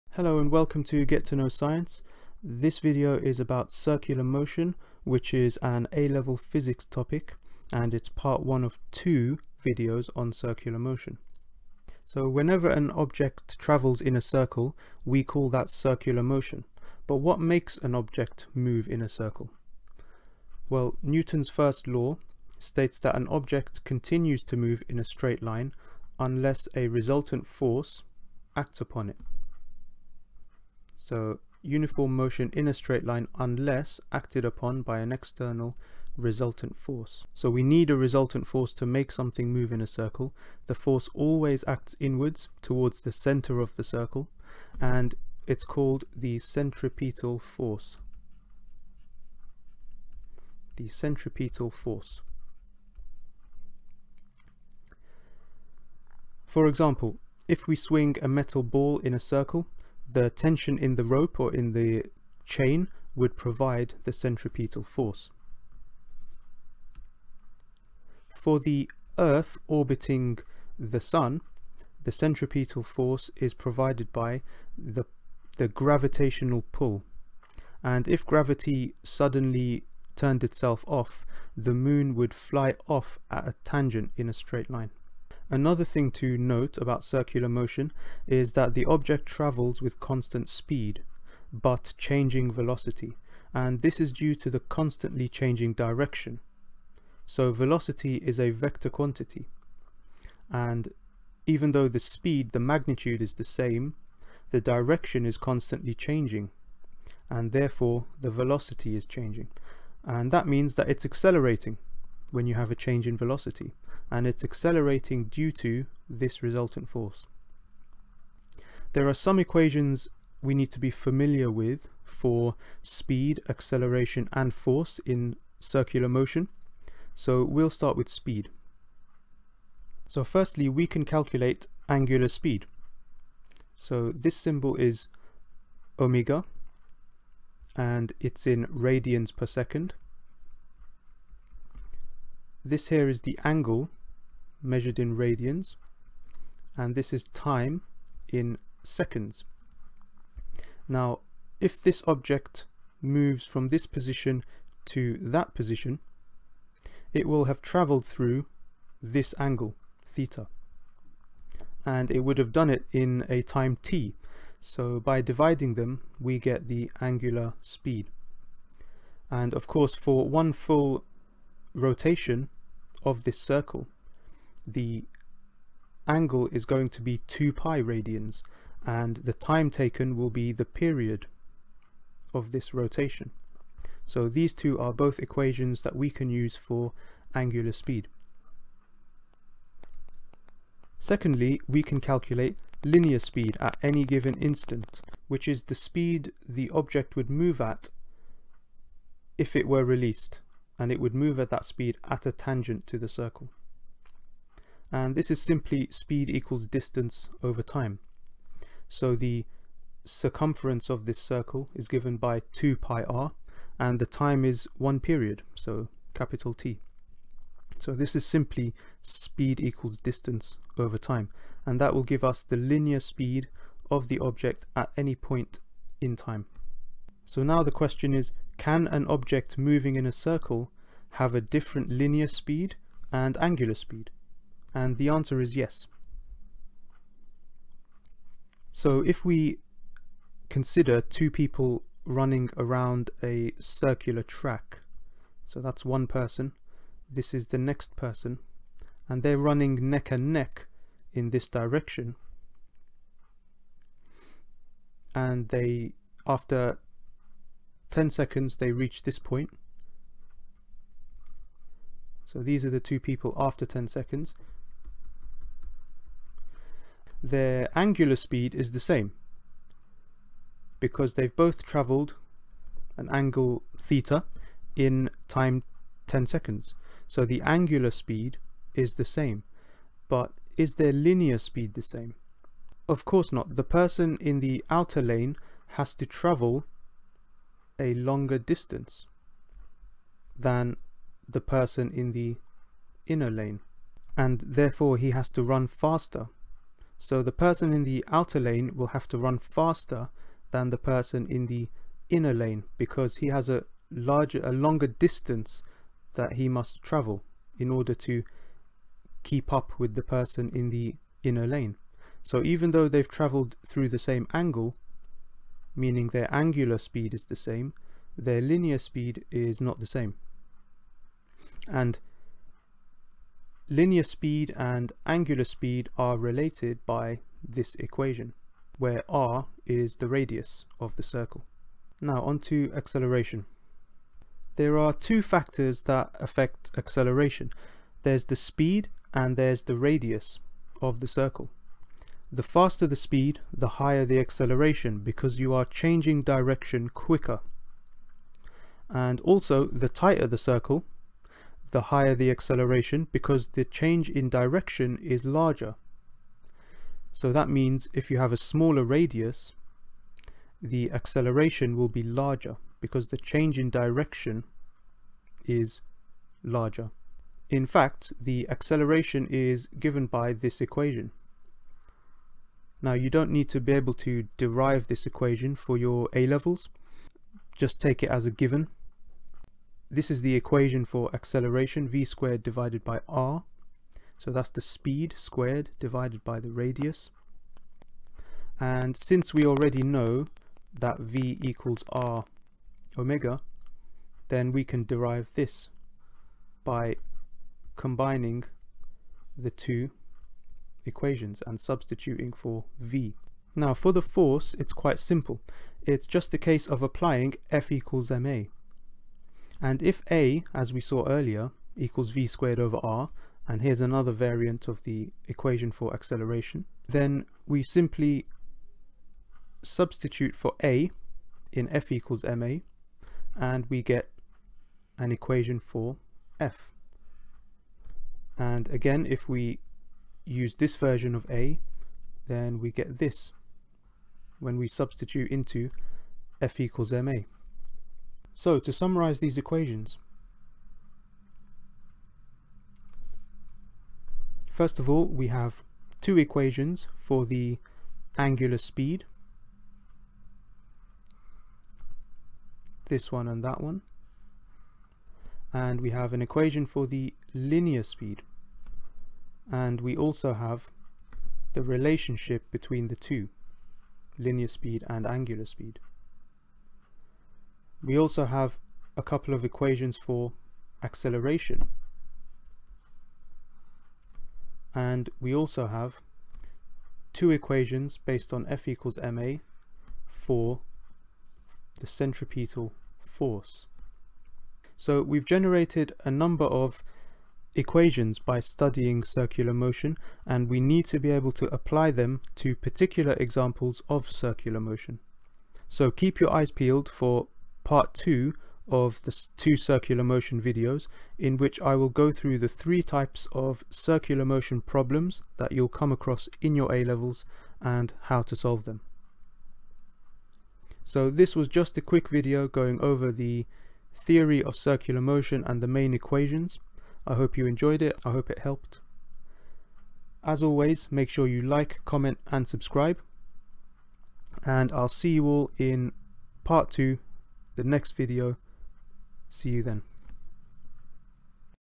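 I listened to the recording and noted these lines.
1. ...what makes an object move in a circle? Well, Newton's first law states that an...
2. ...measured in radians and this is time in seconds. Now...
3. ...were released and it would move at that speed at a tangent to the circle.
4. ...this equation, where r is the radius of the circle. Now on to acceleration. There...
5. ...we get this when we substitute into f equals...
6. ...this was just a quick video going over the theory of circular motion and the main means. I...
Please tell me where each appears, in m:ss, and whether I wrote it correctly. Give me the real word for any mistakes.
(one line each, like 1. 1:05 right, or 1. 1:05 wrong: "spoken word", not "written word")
1. 0:17 right
2. 2:24 right
3. 3:19 right
4. 5:27 right
5. 7:12 right
6. 8:31 wrong: "equations", not "means".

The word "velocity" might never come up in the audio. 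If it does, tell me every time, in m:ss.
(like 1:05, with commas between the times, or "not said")
1:32, 1:37, 1:48, 1:53.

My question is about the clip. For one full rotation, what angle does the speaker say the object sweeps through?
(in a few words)
2 pi radians.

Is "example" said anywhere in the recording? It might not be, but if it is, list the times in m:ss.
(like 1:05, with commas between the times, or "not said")
0:56, 8:13.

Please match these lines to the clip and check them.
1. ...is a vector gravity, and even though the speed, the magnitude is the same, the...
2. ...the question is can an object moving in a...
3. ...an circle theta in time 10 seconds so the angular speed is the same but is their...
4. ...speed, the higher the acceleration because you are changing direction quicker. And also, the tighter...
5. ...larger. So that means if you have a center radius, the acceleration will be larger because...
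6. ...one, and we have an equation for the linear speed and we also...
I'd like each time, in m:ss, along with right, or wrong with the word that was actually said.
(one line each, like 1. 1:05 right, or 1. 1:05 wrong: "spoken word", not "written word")
1. 1:38 wrong: "quantity", not "gravity"
2. 3:47 right
3. 4:32 wrong: "angle", not "circle"
4. 5:42 right
5. 5:55 wrong: "smaller", not "center"
6. 7:33 right.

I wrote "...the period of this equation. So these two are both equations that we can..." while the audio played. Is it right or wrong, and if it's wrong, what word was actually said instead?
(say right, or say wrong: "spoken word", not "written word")
wrong: "rotation", not "equation".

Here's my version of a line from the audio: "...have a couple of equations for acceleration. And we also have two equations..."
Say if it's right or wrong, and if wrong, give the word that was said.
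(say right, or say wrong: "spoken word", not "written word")
right.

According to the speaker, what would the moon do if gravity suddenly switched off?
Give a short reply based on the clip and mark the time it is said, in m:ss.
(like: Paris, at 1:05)
fly off at a tangent, at 1:22.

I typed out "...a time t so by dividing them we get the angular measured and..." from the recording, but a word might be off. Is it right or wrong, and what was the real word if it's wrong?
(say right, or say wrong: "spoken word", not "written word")
wrong: "speed", not "measured".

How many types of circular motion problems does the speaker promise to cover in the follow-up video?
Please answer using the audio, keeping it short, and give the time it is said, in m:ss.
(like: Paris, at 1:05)
3, at 8:22.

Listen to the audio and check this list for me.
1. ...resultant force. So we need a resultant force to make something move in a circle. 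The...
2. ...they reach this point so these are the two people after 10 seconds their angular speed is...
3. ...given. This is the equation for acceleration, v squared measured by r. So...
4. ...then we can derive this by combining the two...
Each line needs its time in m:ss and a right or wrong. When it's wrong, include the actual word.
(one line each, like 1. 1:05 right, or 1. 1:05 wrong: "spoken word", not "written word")
1. 0:36 right
2. 4:18 right
3. 6:18 wrong: "divided", not "measured"
4. 6:34 right.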